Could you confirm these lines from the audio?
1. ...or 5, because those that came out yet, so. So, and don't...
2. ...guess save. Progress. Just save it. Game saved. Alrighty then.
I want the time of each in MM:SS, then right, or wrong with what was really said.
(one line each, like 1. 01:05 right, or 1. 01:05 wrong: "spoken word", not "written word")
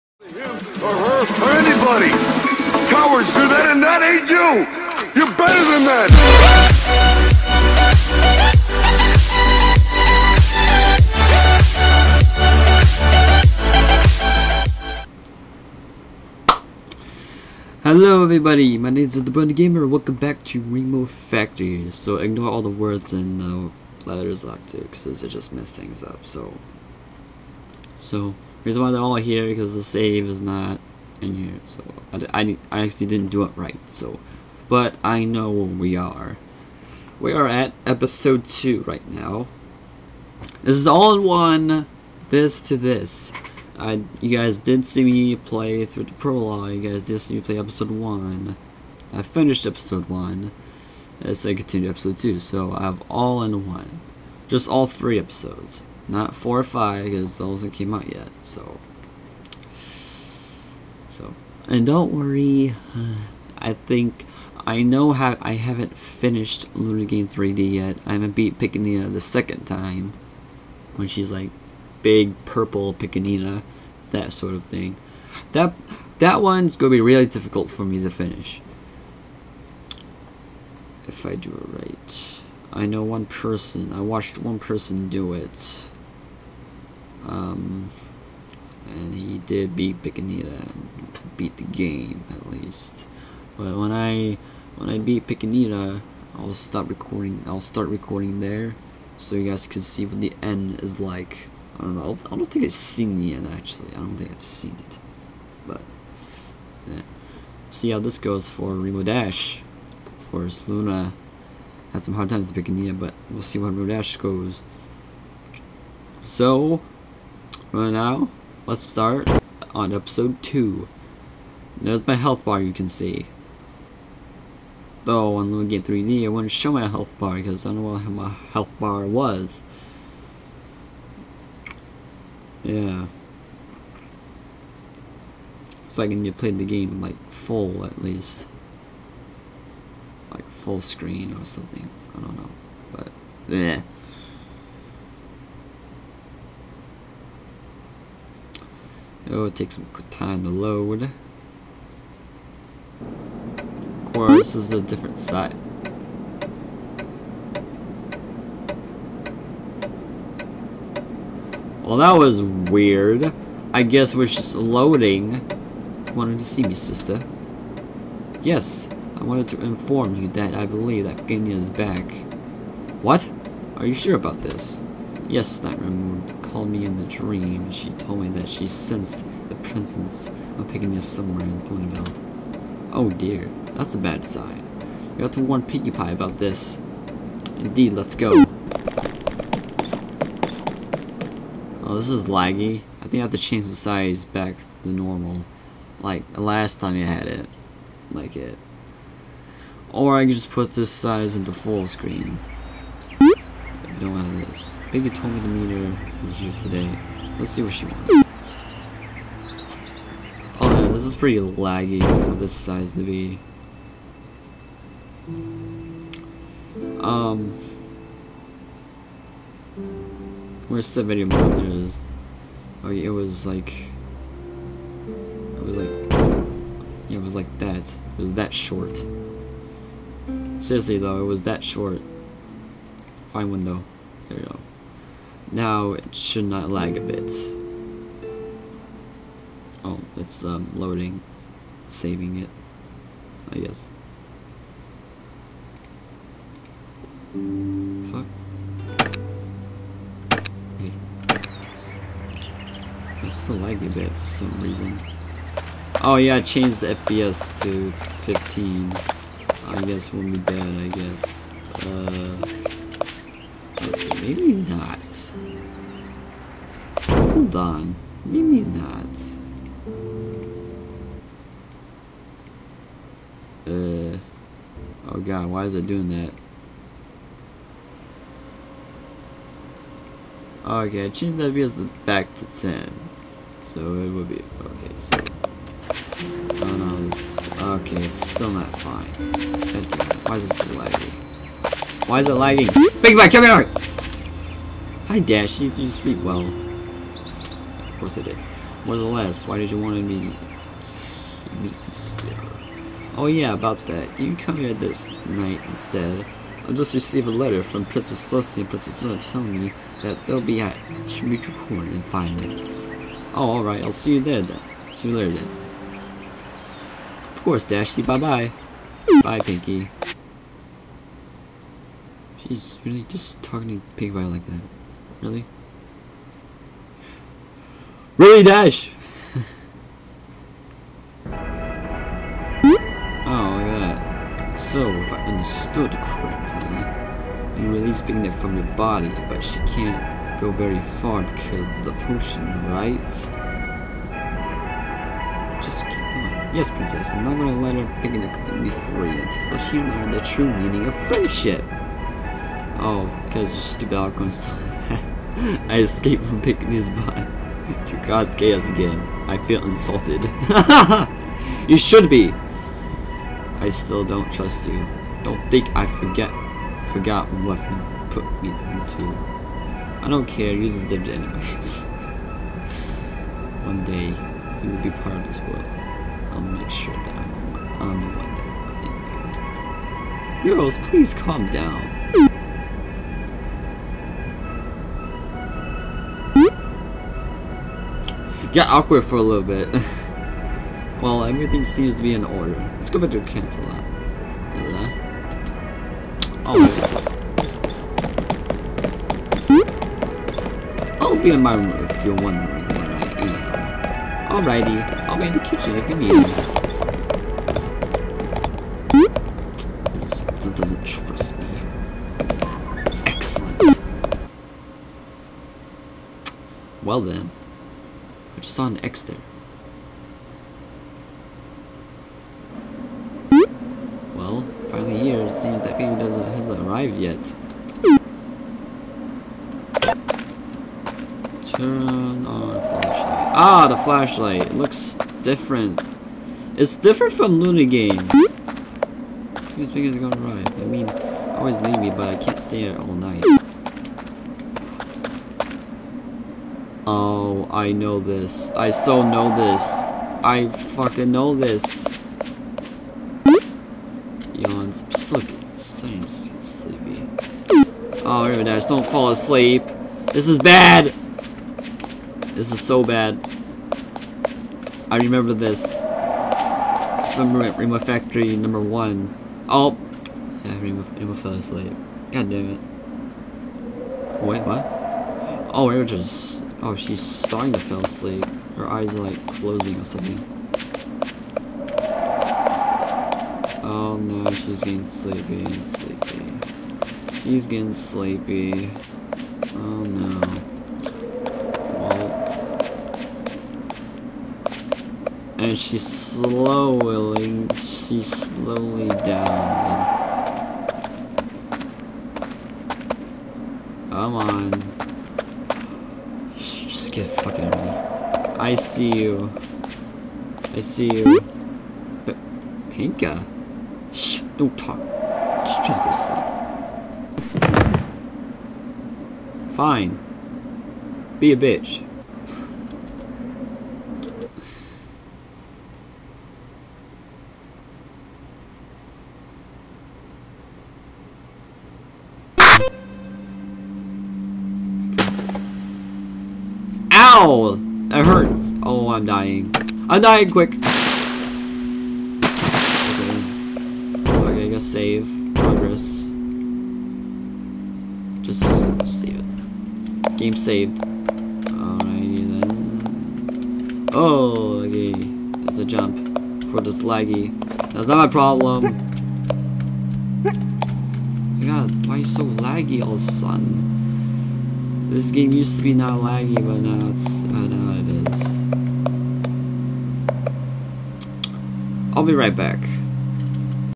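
1. 00:56 right
2. 09:04 right.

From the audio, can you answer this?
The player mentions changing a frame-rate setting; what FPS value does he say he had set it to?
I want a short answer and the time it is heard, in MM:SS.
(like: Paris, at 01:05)
15, at 04:18.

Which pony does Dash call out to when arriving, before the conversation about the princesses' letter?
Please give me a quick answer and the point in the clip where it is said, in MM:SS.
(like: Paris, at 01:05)
Big Mac, at 04:53.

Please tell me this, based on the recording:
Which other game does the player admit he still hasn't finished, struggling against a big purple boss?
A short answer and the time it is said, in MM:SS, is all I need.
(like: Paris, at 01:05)
Luna Game 3D, at 01:06.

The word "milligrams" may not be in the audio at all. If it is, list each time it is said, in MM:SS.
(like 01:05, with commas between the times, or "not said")
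not said.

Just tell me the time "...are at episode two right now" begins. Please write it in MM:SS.
00:37.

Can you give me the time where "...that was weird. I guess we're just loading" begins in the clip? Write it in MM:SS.
02:41.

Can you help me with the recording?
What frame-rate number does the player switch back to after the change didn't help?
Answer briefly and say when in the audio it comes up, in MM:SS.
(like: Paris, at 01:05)
10, at 04:42.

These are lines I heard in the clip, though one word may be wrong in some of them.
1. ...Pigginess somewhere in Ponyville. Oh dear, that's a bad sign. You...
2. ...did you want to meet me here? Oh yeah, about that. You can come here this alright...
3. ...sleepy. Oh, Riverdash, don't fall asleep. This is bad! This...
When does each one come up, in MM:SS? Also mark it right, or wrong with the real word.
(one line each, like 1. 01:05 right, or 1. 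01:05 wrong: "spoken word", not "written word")
1. 03:00 right
2. 04:59 wrong: "night", not "alright"
3. 07:36 right.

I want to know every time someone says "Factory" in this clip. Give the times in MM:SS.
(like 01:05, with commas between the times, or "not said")
00:21, 07:47.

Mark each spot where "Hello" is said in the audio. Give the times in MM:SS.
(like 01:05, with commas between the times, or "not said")
00:17.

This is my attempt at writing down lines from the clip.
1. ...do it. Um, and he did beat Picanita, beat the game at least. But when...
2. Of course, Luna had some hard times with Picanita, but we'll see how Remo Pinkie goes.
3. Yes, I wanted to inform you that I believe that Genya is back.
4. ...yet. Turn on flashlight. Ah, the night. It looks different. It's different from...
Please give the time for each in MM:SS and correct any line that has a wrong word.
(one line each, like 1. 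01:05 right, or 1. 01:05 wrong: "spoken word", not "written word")
1. 01:25 right
2. 01:49 wrong: "Dash", not "Pinkie"
3. 02:48 right
4. 07:06 wrong: "flashlight", not "night".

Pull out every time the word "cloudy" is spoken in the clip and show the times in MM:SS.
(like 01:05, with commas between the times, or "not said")
not said.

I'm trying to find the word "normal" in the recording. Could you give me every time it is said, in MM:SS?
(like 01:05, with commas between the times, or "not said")
03:14.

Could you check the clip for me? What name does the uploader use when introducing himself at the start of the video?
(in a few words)
The Brony Gamer.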